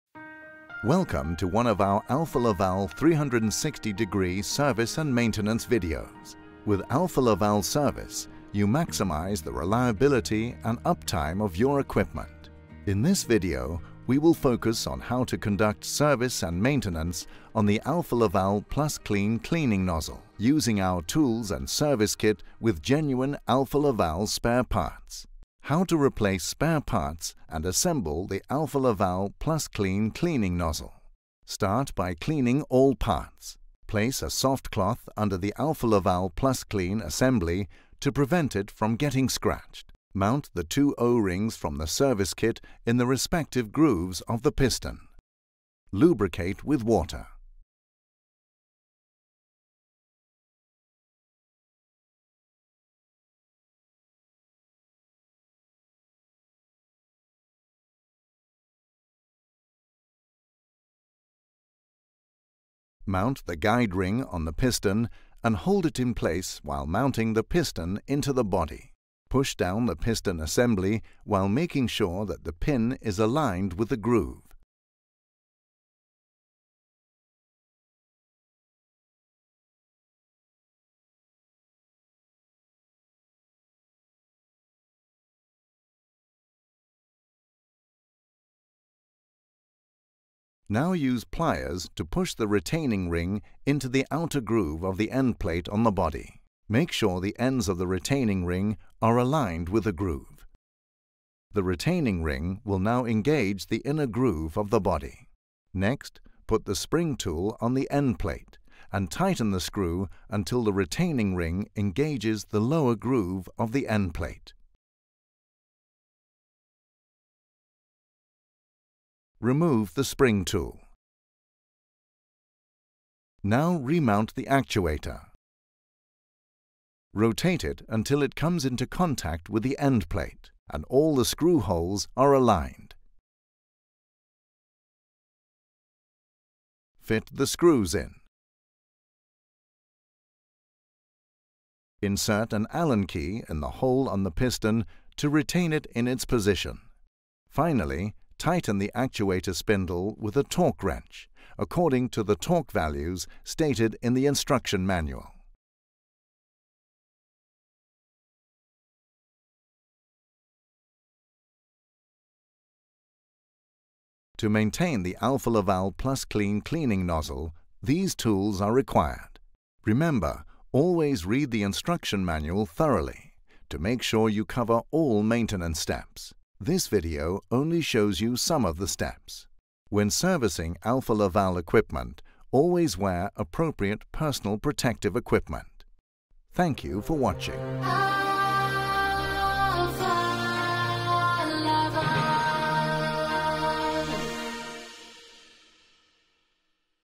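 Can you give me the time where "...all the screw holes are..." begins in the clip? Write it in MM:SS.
02:10.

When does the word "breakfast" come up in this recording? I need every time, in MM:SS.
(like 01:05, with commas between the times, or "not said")
not said.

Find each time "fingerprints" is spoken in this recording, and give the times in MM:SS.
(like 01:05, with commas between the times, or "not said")
not said.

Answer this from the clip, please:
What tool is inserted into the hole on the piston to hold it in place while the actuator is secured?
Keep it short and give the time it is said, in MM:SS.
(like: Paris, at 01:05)
An Allen key, at 02:22.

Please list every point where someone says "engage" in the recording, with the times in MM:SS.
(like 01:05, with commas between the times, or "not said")
01:43, 01:51.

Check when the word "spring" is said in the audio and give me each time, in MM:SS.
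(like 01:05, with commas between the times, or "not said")
01:46, 02:00.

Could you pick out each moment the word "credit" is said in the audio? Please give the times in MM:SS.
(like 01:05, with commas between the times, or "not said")
not said.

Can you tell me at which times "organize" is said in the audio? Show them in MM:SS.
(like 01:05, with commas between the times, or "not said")
not said.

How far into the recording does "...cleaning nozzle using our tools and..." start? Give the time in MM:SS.
00:19.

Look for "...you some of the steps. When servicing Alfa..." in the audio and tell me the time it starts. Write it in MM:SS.
02:58.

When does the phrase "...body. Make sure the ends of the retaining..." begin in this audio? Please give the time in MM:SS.
01:35.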